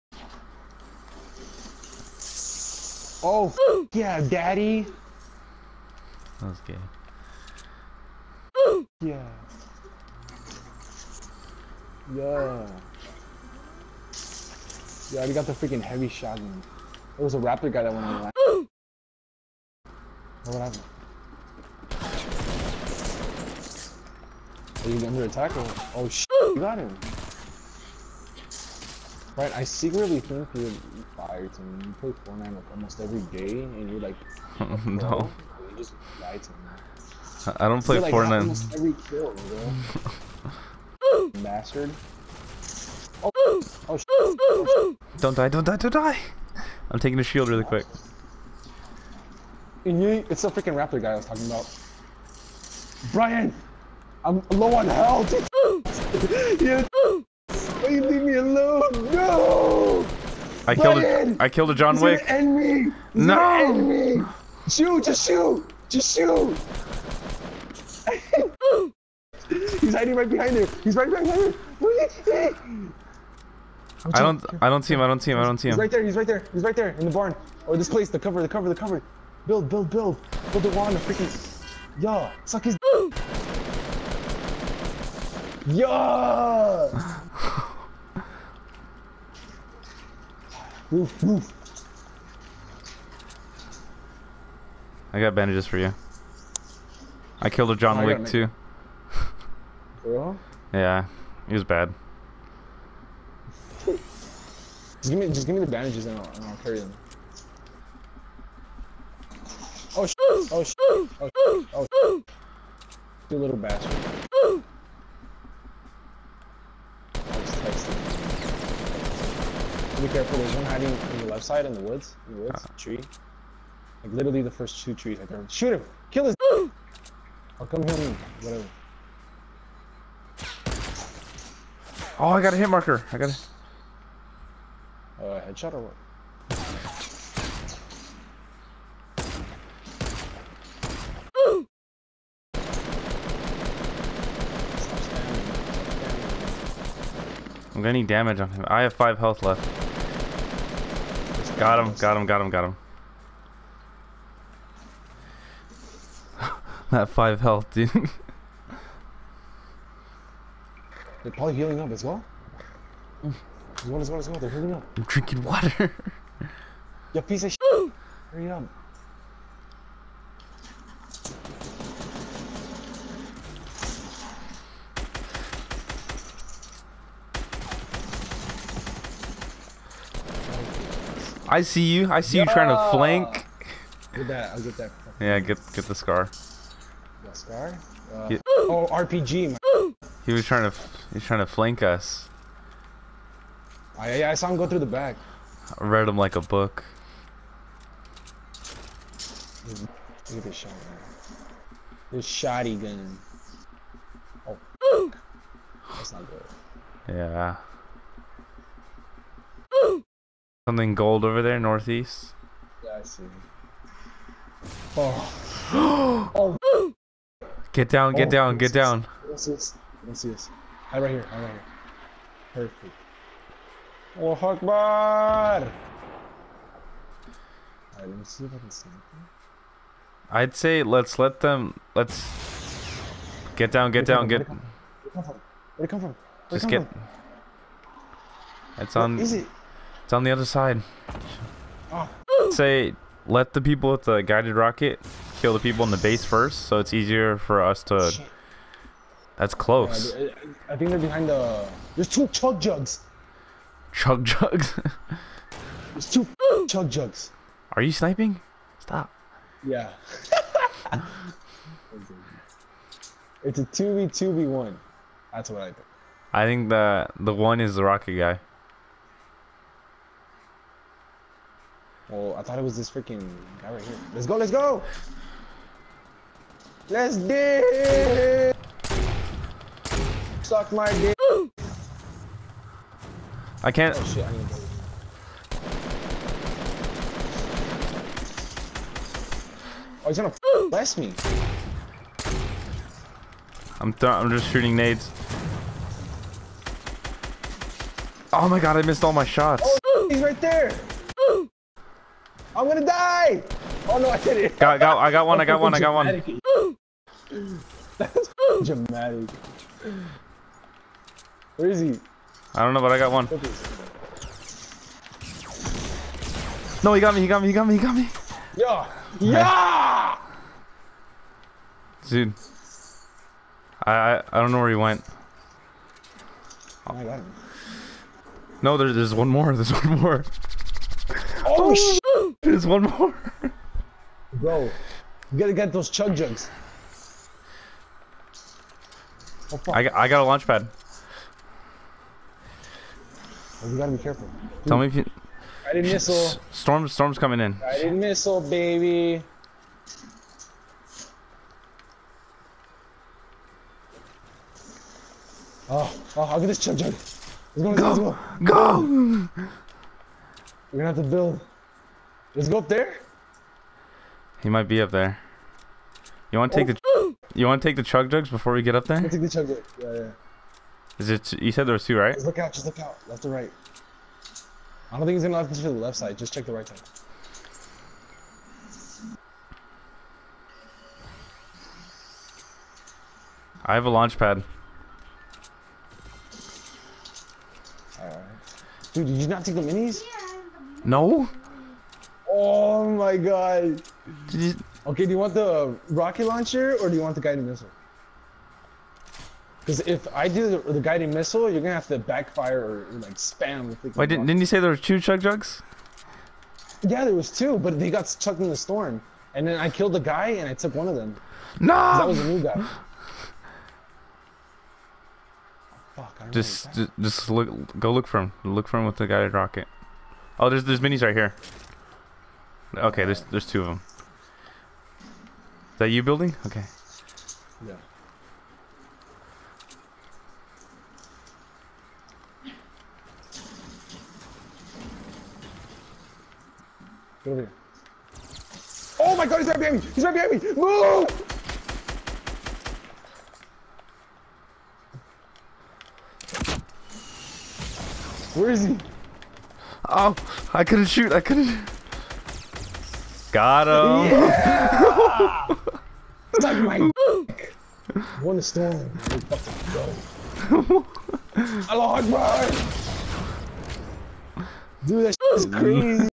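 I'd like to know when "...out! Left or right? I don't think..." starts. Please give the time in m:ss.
6:12.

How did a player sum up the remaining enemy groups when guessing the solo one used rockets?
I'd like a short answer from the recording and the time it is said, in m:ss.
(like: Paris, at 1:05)
2v2v1, at 4:23.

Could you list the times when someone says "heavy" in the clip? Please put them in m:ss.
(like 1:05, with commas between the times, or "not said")
0:15.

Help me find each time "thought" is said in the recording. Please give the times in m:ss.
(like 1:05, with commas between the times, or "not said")
4:32.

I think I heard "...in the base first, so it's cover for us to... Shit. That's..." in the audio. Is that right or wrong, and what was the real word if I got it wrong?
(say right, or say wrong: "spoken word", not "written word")
wrong: "easier", not "cover".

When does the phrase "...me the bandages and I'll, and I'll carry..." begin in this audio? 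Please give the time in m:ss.
1:45.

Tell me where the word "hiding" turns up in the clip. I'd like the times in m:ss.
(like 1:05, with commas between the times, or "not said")
1:09, 2:00.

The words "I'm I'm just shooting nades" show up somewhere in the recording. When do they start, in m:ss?
4:53.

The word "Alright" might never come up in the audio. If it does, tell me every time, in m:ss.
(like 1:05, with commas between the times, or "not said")
3:45, 6:27.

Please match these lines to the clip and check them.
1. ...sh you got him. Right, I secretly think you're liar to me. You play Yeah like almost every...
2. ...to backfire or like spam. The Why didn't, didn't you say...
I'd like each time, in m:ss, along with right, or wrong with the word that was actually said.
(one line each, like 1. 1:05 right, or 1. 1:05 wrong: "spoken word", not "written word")
1. 0:26 wrong: "Fortnite", not "Yeah"
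2. 6:41 right.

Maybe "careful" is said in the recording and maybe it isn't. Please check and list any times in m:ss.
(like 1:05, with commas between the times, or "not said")
2:00, 5:44.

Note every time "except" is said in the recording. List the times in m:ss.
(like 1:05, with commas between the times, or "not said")
not said.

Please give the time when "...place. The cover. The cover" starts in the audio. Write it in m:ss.
1:17.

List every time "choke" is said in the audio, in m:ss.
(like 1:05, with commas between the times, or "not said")
not said.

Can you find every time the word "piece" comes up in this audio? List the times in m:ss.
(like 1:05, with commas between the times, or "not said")
2:47.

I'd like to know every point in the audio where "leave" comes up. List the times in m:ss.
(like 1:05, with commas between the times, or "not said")
0:58.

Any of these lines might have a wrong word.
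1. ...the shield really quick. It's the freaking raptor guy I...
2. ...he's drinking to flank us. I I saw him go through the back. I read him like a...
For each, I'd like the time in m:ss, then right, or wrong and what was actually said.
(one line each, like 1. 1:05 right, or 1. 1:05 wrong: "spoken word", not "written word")
1. 0:47 right
2. 3:11 wrong: "trying", not "drinking".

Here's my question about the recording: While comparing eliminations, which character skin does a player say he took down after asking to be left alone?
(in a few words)
John Wick.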